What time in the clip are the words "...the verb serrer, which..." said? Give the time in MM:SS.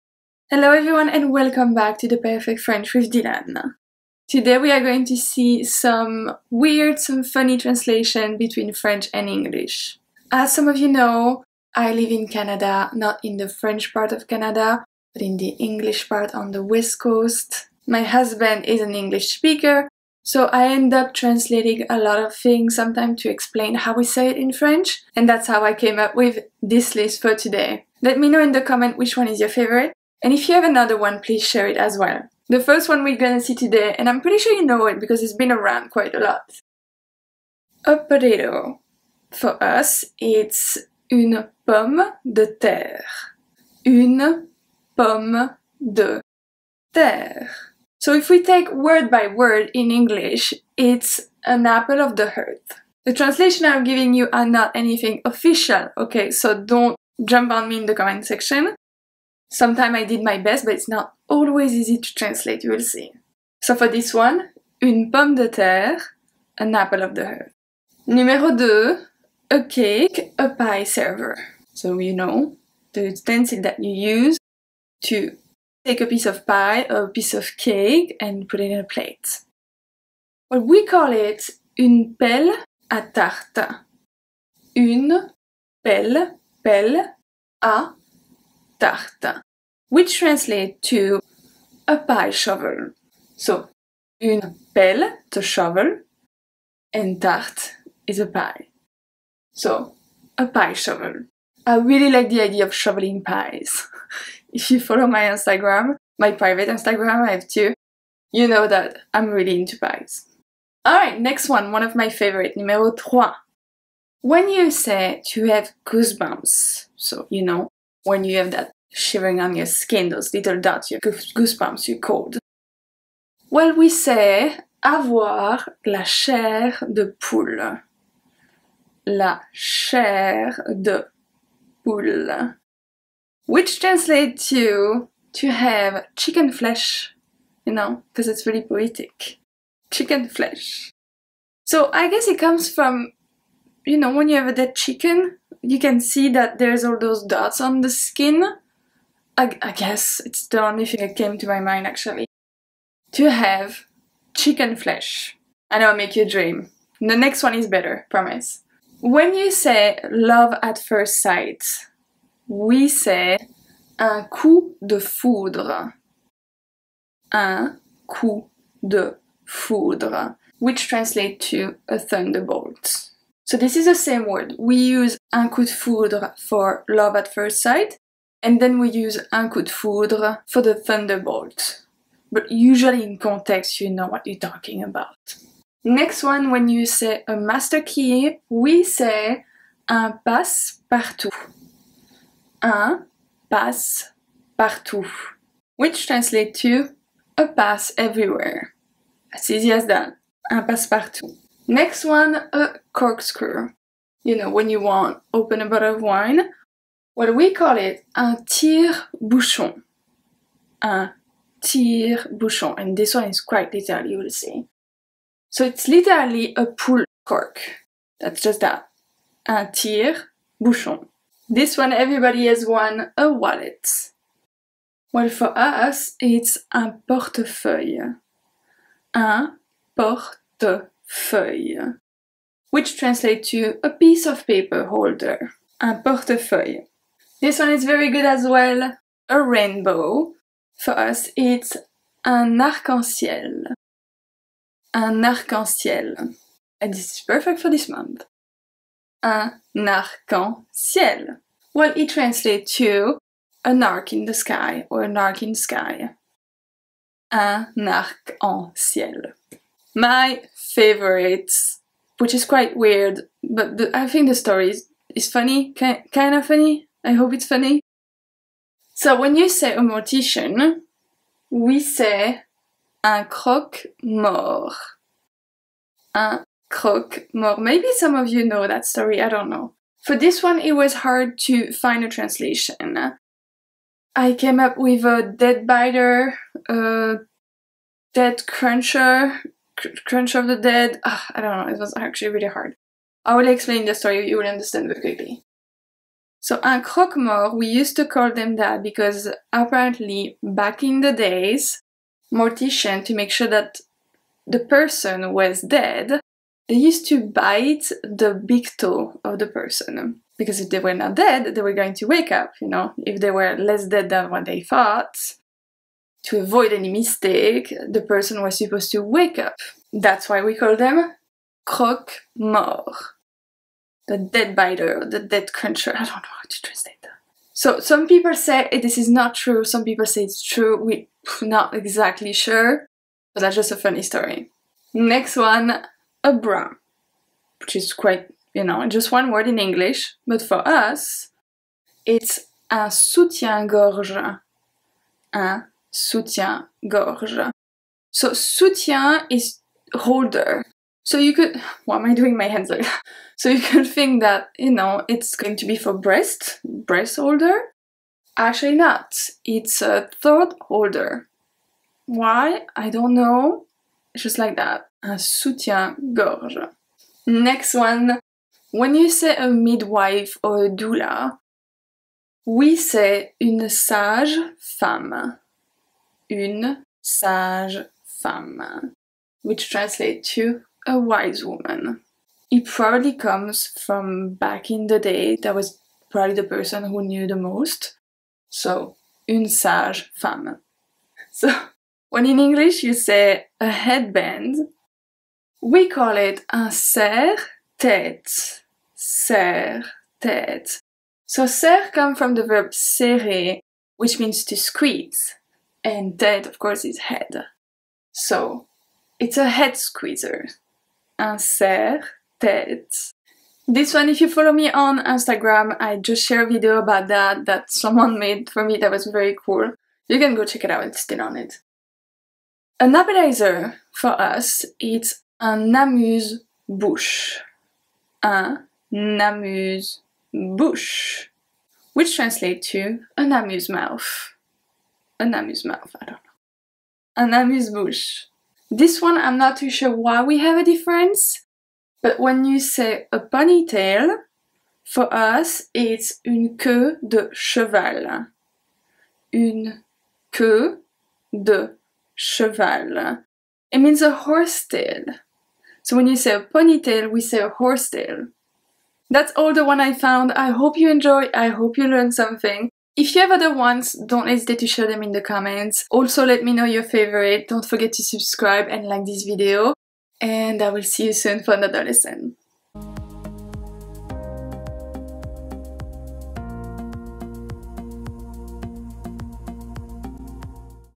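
06:42.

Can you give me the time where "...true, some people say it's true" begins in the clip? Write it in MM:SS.
05:29.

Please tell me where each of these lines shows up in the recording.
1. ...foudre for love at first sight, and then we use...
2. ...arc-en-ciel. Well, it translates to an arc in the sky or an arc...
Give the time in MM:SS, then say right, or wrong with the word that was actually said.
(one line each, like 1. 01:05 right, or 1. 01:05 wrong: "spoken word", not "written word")
1. 02:55 right
2. 04:09 right.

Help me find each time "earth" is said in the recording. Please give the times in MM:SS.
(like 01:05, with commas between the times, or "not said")
00:52, 01:07.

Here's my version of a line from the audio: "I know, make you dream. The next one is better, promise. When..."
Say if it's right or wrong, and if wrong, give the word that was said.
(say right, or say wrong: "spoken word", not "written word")
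right.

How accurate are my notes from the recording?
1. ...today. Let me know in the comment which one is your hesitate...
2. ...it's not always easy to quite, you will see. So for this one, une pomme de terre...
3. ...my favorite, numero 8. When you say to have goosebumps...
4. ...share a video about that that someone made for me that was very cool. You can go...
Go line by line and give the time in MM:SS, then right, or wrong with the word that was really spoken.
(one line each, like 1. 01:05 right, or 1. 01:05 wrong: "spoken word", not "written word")
1. 00:27 wrong: "favorite", not "hesitate"
2. 01:00 wrong: "translate", not "quite"
3. 01:51 wrong: "3", not "8"
4. 06:56 right.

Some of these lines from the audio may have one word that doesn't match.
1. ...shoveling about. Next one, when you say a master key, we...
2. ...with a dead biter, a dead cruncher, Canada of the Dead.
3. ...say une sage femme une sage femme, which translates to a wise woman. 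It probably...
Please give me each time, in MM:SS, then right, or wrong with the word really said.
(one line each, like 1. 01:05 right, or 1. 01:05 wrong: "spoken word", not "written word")
1. 03:04 wrong: "talking", not "shoveling"
2. 04:44 wrong: "Crunch", not "Canada"
3. 06:12 right.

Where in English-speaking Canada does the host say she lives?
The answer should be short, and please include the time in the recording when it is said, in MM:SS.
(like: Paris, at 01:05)
west coast, at 00:16.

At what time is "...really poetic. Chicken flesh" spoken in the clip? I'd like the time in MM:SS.
02:18.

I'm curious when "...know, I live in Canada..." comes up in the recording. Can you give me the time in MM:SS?
00:10.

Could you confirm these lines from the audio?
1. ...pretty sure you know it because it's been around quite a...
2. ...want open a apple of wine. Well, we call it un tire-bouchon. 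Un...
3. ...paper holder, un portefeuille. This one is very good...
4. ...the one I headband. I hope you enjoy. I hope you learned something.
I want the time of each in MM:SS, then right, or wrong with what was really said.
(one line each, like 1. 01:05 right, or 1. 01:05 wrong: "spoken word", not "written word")
1. 00:34 right
2. 03:24 wrong: "bottle", not "apple"
3. 03:54 right
4. 07:39 wrong: "found", not "headband".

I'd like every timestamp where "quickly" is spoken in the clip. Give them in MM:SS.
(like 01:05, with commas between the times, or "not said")
04:55.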